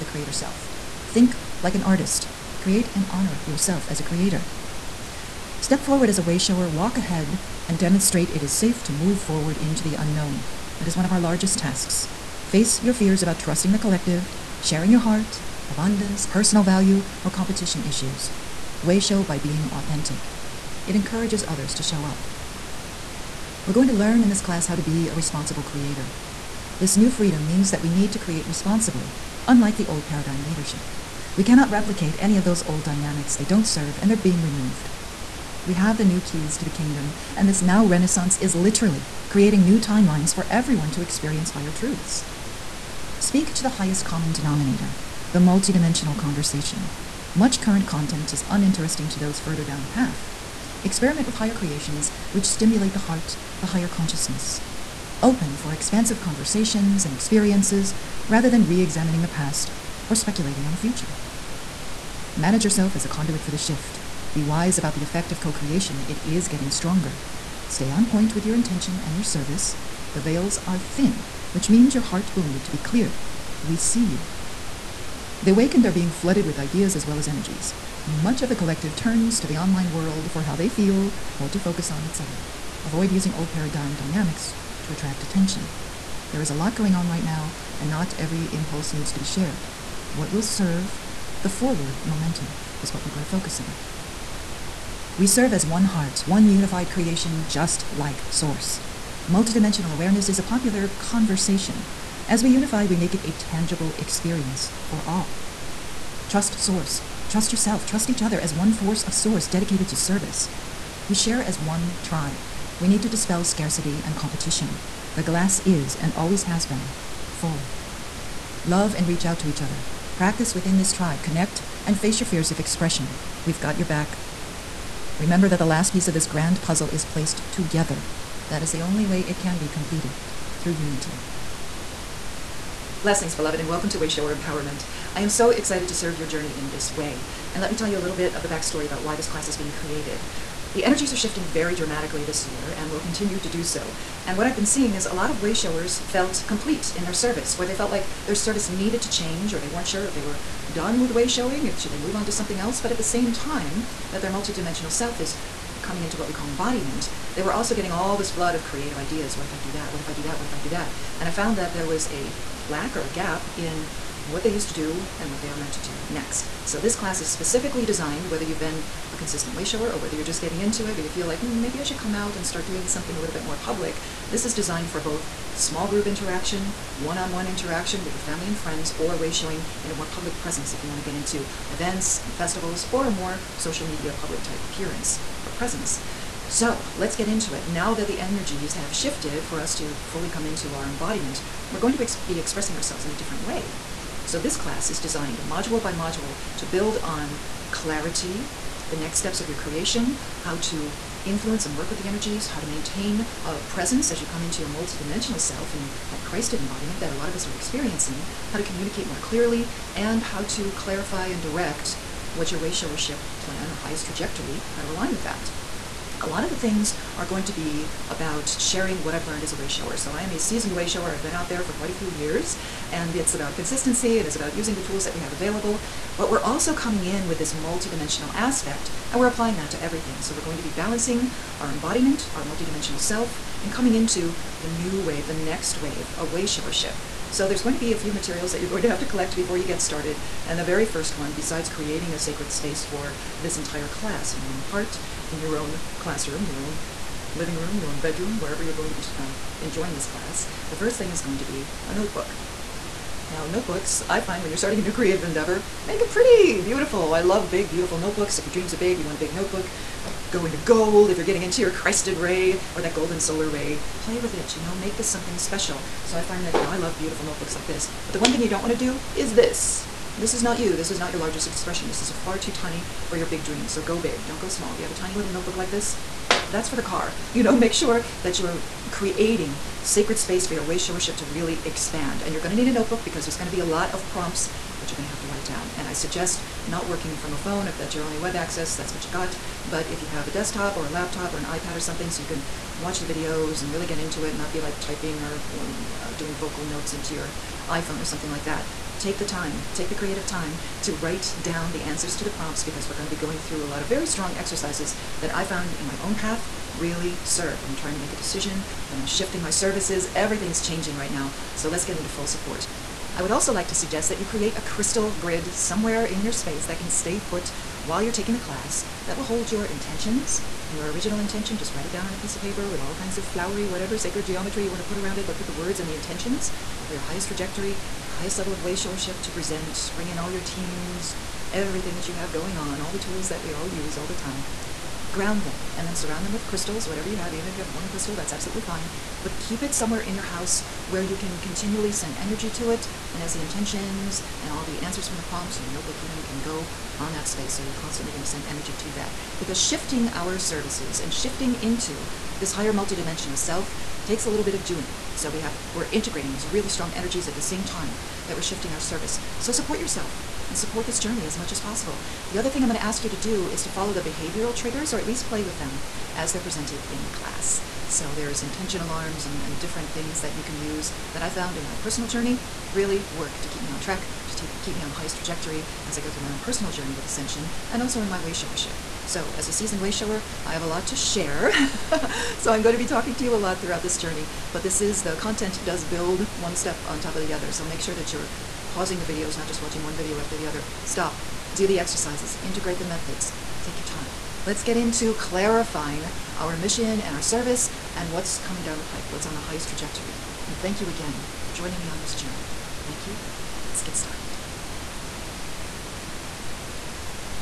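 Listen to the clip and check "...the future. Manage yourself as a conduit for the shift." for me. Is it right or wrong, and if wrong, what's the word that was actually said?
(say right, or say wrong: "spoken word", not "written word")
right.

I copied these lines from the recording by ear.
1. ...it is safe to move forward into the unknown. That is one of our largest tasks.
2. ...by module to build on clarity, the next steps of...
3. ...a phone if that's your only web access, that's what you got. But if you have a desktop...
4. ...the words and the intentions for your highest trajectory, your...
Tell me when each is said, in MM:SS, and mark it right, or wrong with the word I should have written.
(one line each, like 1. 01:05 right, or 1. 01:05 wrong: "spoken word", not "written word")
1. 00:08 right
2. 03:15 right
3. 04:47 right
4. 05:25 right.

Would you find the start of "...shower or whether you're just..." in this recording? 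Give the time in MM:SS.
02:49.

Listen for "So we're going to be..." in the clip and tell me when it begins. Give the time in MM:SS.
03:50.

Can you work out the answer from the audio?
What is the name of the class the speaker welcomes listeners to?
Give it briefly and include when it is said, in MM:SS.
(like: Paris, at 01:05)
Wayshower Empowerment, at 02:13.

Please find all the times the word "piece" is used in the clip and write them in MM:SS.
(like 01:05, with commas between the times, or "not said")
02:05, 05:22.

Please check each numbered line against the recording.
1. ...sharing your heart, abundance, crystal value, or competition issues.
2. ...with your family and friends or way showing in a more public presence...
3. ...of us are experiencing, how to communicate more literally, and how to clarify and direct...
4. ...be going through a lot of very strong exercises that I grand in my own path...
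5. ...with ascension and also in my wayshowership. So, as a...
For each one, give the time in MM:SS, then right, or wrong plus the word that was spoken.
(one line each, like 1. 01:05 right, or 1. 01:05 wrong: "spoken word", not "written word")
1. 00:14 wrong: "personal", not "crystal"
2. 02:58 right
3. 03:27 wrong: "clearly", not "literally"
4. 05:03 wrong: "found", not "grand"
5. 06:16 right.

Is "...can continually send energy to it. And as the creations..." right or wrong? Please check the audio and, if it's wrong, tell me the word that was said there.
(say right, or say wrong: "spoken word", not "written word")
wrong: "intentions", not "creations".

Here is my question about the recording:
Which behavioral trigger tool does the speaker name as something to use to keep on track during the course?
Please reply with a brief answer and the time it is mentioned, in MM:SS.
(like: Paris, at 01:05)
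Intention alarms, at 06:08.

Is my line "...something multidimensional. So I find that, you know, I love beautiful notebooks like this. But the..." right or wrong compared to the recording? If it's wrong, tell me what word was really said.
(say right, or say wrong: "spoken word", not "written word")
wrong: "special", not "multidimensional".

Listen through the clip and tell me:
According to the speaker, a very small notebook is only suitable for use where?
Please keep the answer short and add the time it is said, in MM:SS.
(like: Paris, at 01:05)
The car, at 04:36.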